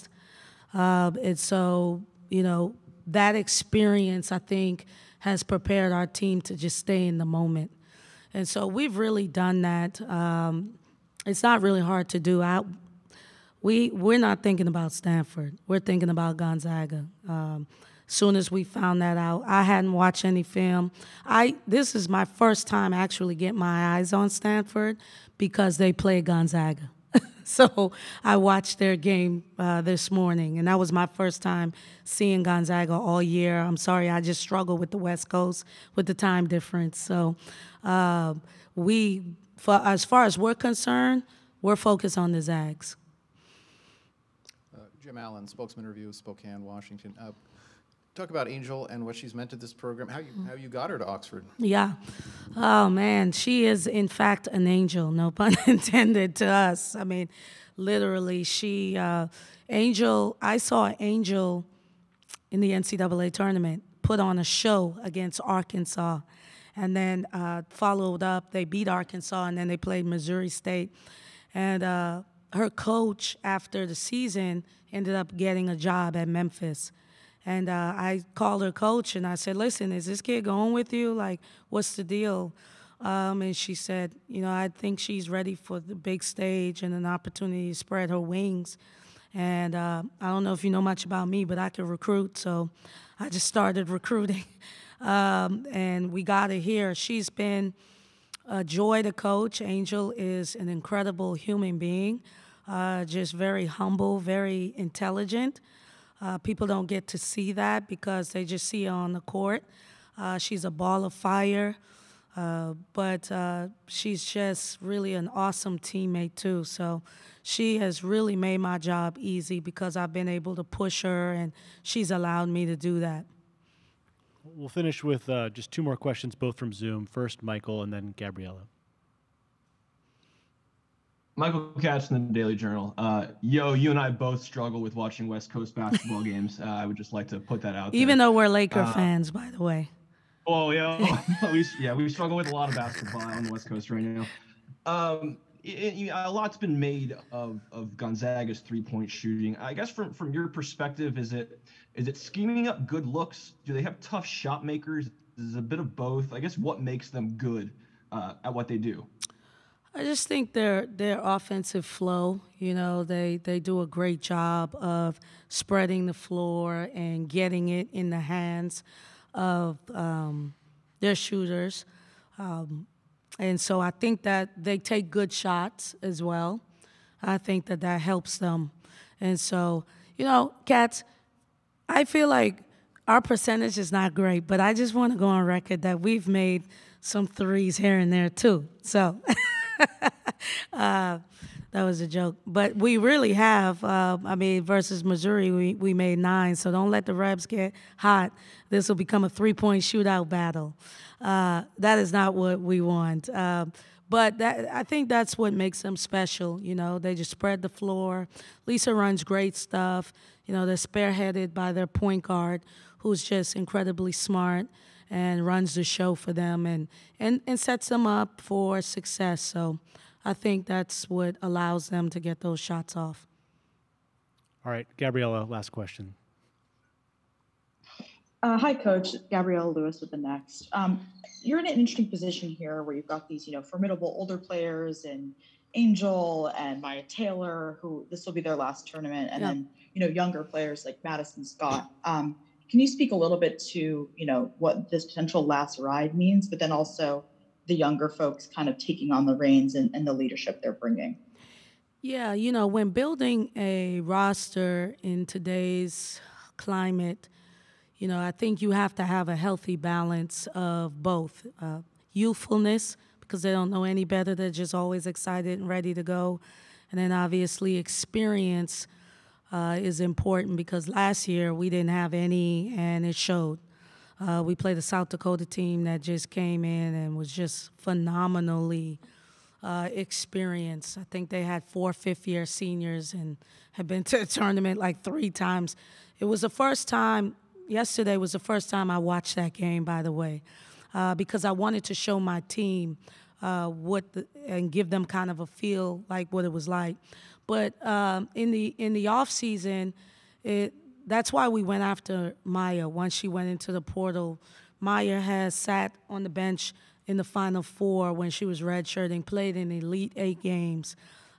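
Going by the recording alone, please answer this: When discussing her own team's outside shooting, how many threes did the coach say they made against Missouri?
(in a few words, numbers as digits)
9.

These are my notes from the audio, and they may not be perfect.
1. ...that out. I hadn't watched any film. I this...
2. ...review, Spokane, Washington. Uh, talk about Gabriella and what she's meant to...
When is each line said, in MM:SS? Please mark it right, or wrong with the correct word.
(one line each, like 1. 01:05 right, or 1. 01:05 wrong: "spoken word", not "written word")
1. 00:19 right
2. 00:45 wrong: "Angel", not "Gabriella".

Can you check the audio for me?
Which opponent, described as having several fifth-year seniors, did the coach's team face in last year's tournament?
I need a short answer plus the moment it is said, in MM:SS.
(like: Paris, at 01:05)
South Dakota, at 04:34.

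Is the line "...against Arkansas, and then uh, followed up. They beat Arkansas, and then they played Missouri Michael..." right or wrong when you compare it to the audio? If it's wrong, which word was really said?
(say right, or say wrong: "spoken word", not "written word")
wrong: "State", not "Michael".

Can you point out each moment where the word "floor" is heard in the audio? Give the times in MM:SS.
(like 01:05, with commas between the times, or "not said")
02:46, 03:27.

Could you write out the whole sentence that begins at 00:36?
So uh, we, for, as far as we're concerned, we're focused on the Zags.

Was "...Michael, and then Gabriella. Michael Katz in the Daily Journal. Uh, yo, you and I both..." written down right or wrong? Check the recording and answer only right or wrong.
right.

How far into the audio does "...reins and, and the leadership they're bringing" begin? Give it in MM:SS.
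04:09.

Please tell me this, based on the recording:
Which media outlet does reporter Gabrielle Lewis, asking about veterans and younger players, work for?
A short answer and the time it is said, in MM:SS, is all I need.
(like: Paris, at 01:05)
The Next, at 03:50.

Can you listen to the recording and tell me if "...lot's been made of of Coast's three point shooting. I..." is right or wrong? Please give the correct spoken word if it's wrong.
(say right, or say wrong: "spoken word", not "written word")
wrong: "Gonzaga", not "Coast".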